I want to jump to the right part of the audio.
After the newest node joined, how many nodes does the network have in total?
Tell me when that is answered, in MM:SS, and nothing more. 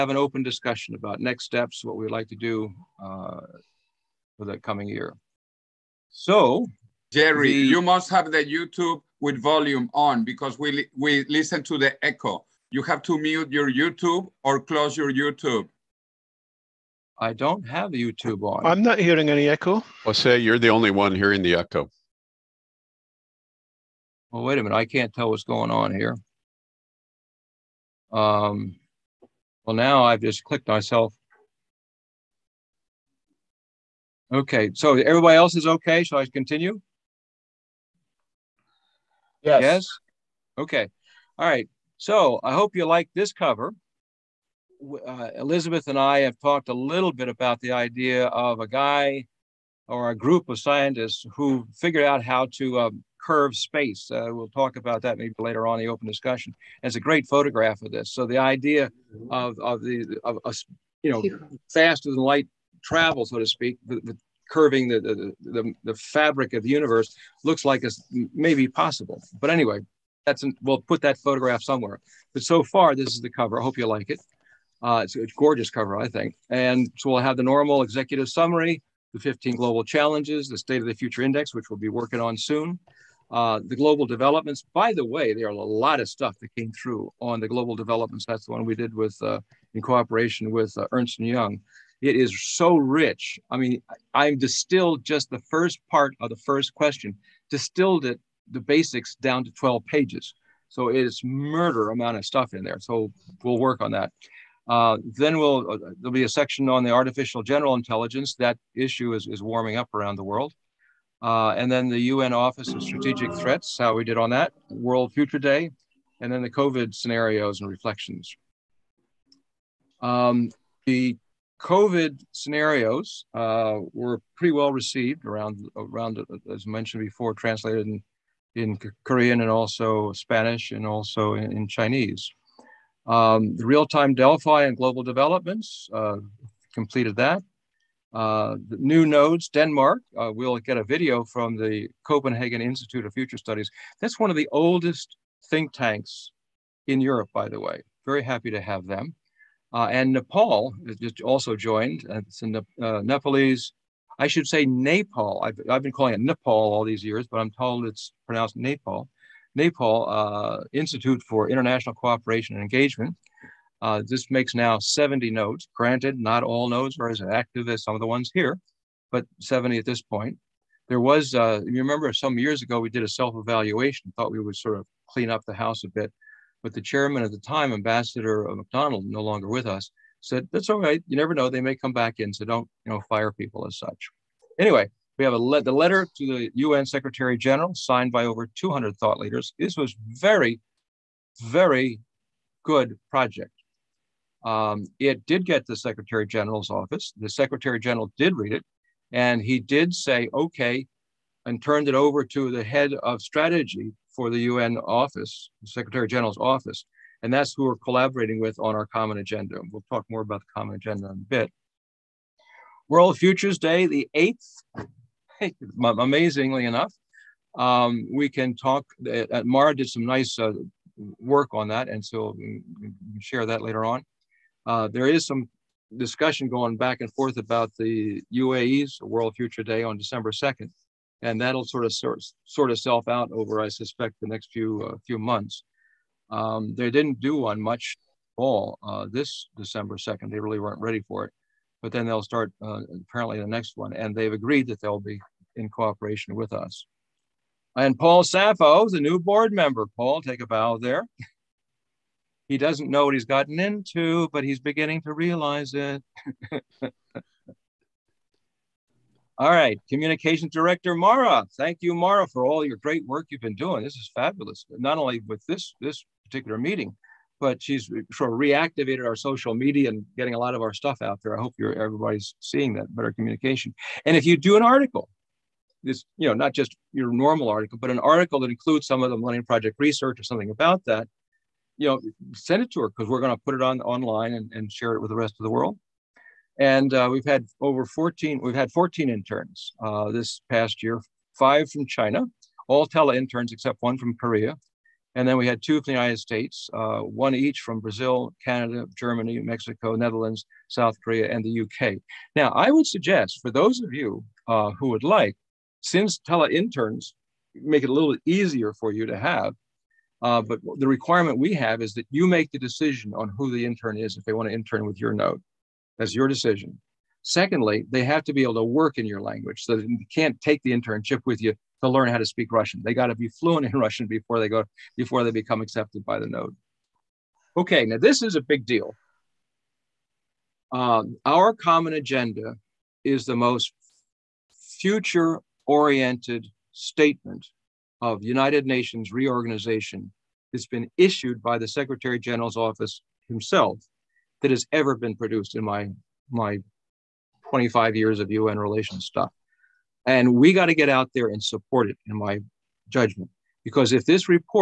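02:44.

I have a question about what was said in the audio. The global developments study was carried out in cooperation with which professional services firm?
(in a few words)
Ernst and Young.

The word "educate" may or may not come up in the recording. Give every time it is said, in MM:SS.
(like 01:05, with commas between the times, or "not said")
not said.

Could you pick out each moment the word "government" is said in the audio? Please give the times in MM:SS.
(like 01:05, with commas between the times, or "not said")
not said.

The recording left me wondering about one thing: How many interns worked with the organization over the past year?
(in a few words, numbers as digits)
14.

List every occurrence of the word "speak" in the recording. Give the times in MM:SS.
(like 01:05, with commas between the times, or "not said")
01:03, 05:22.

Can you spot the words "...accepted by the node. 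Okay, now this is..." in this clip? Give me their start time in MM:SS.
05:25.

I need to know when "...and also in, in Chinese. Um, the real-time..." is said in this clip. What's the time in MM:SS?
02:10.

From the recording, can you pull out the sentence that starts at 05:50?
And we got to get out there and support it, in my judgment.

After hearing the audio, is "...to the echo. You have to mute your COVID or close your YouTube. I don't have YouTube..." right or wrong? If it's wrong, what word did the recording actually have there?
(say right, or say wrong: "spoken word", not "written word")
wrong: "YouTube", not "COVID".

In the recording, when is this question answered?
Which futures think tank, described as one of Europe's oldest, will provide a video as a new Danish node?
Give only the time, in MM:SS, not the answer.
02:22.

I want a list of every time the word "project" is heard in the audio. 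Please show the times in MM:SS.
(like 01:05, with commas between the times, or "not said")
03:13, 04:39.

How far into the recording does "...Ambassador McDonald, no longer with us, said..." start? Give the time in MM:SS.
02:57.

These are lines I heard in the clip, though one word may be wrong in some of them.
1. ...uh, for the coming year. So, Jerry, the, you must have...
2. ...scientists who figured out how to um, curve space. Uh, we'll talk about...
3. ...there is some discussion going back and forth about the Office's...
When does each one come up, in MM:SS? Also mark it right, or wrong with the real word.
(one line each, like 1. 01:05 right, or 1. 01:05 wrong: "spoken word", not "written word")
1. 00:03 right
2. 00:50 right
3. 03:44 wrong: "UAE", not "Office".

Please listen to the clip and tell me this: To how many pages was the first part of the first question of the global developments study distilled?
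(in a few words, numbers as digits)
12.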